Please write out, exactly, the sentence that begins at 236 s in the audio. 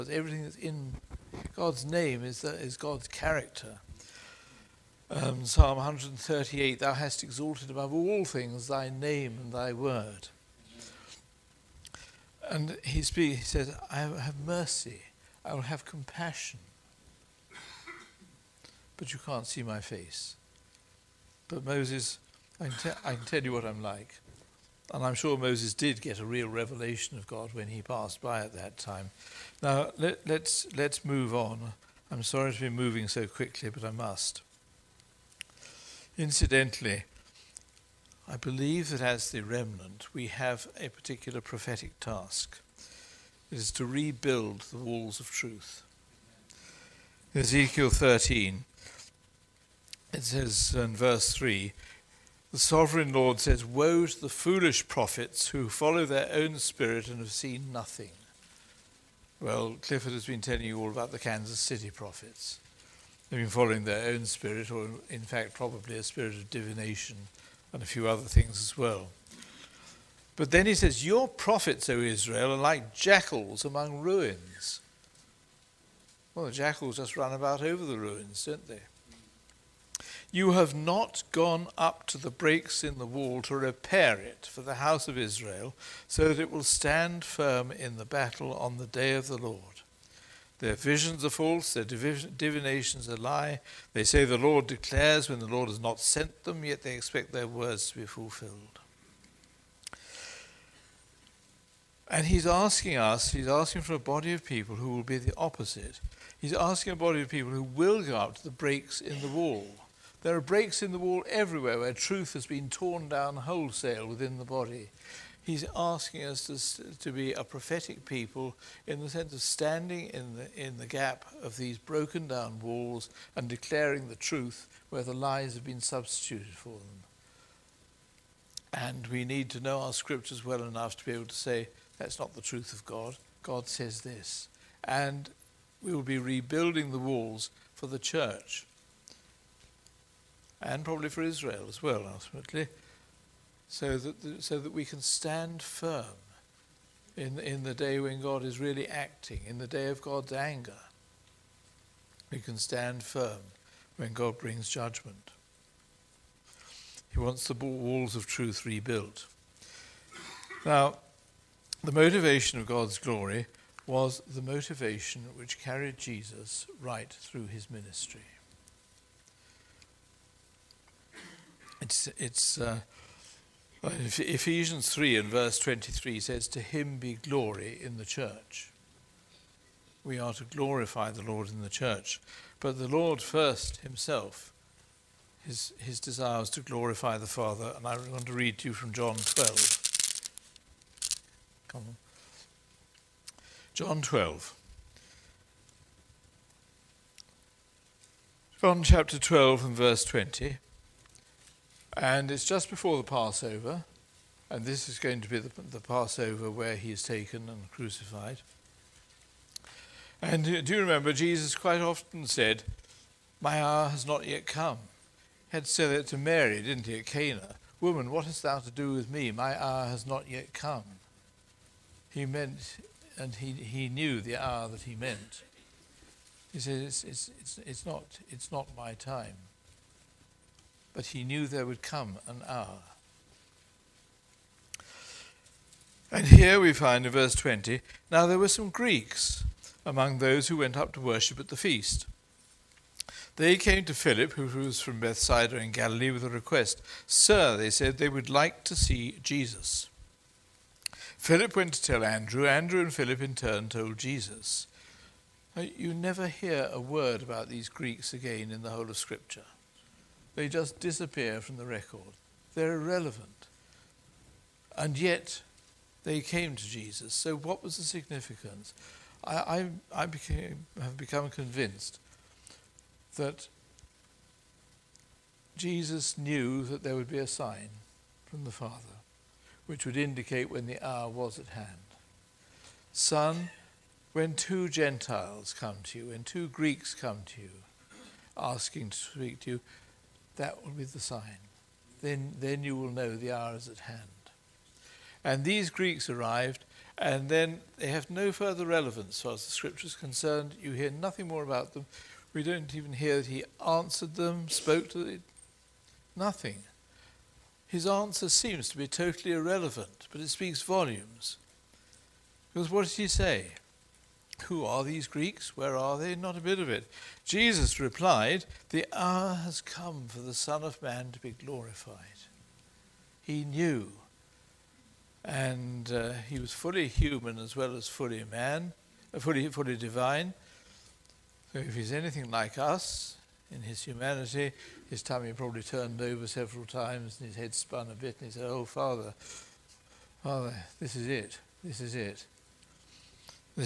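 And here we find in verse 20 now there were some Greeks among those who went up to worship at the feast.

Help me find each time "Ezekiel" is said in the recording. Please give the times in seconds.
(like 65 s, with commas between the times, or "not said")
47 s.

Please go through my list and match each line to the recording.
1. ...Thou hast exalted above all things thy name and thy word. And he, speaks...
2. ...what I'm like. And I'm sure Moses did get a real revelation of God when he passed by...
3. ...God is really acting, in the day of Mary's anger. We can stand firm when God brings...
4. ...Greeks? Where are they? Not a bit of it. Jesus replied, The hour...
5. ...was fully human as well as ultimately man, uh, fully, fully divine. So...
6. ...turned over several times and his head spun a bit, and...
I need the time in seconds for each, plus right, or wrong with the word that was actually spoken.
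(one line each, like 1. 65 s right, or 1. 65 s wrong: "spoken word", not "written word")
1. 6 s right
2. 23 s right
3. 148 s wrong: "God", not "Mary"
4. 315 s right
5. 326 s wrong: "fully", not "ultimately"
6. 335 s right.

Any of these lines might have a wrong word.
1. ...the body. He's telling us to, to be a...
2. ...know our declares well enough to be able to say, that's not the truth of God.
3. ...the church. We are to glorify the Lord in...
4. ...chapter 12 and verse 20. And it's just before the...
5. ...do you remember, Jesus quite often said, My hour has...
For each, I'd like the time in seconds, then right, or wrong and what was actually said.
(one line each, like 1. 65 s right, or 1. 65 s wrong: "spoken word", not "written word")
1. 114 s wrong: "asking", not "telling"
2. 129 s wrong: "scriptures", not "declares"
3. 177 s right
4. 198 s right
5. 210 s right.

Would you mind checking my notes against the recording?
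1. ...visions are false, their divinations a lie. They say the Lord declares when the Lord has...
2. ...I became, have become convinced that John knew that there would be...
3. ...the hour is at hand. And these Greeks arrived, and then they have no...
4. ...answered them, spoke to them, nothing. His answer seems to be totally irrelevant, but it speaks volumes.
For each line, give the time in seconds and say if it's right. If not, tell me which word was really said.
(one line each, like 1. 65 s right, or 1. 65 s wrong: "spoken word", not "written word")
1. 90 s right
2. 269 s wrong: "Jesus", not "John"
3. 293 s right
4. 303 s right.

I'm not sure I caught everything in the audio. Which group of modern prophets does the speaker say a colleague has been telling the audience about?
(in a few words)
The Kansas City prophets.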